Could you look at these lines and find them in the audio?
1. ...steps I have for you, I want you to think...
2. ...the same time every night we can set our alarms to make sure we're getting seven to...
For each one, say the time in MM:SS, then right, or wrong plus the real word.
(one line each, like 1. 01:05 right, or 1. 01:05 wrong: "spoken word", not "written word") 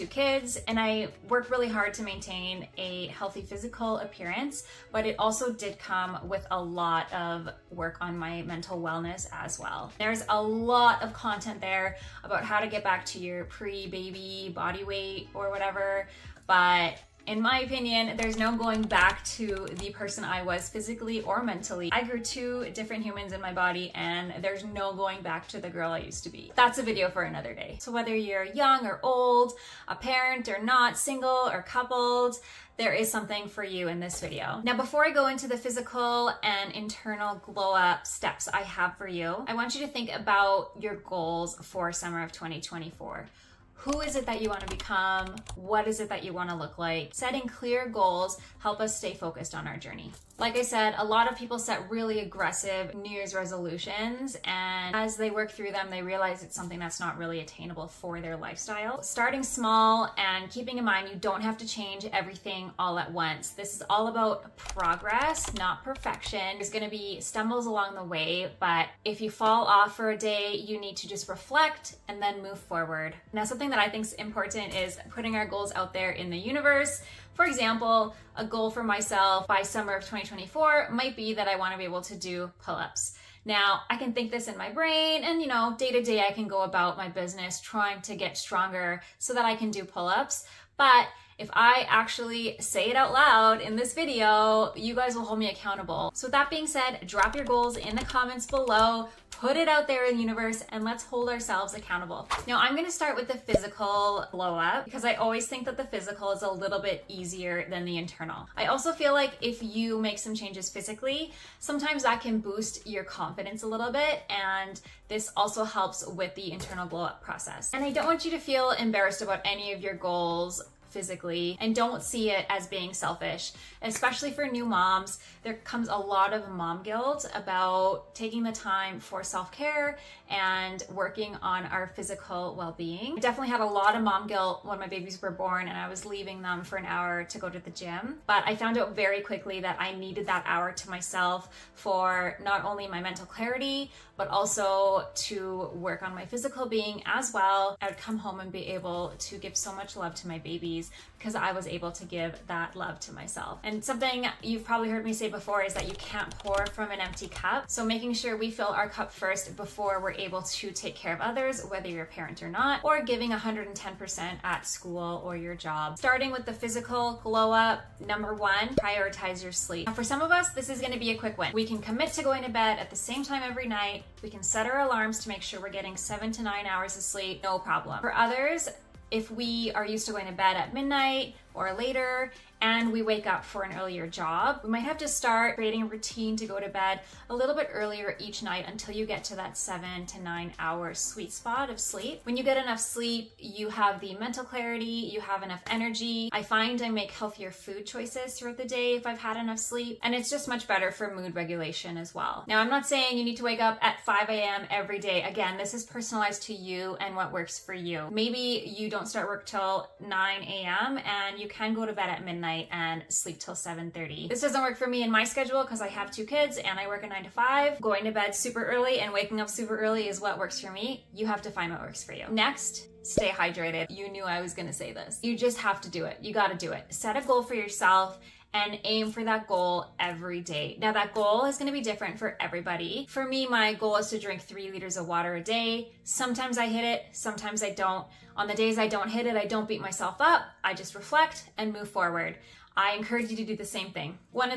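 1. 00:38 right
2. 02:52 right.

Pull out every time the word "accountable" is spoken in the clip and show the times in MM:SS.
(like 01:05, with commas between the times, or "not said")
01:35, 01:41.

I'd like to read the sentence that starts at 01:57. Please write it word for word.
And I don't want you to feel embarrassed about any of your goals physically and don't see it as being selfish.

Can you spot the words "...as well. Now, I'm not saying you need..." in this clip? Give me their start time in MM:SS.
03:21.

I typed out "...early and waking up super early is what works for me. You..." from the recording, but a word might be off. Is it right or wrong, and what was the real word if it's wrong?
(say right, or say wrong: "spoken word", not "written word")
right.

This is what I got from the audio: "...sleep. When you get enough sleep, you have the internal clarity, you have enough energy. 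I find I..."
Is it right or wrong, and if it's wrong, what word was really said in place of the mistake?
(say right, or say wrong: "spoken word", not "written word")
wrong: "mental", not "internal".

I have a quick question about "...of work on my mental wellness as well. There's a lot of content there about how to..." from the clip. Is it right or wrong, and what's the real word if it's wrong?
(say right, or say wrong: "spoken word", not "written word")
right.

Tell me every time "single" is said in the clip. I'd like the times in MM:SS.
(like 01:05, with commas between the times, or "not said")
00:30.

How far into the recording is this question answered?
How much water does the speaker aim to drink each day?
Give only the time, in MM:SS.
03:54.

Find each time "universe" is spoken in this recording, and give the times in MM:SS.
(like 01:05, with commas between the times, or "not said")
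01:16, 01:40.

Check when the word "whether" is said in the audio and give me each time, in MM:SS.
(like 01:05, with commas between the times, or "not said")
00:27, 02:41.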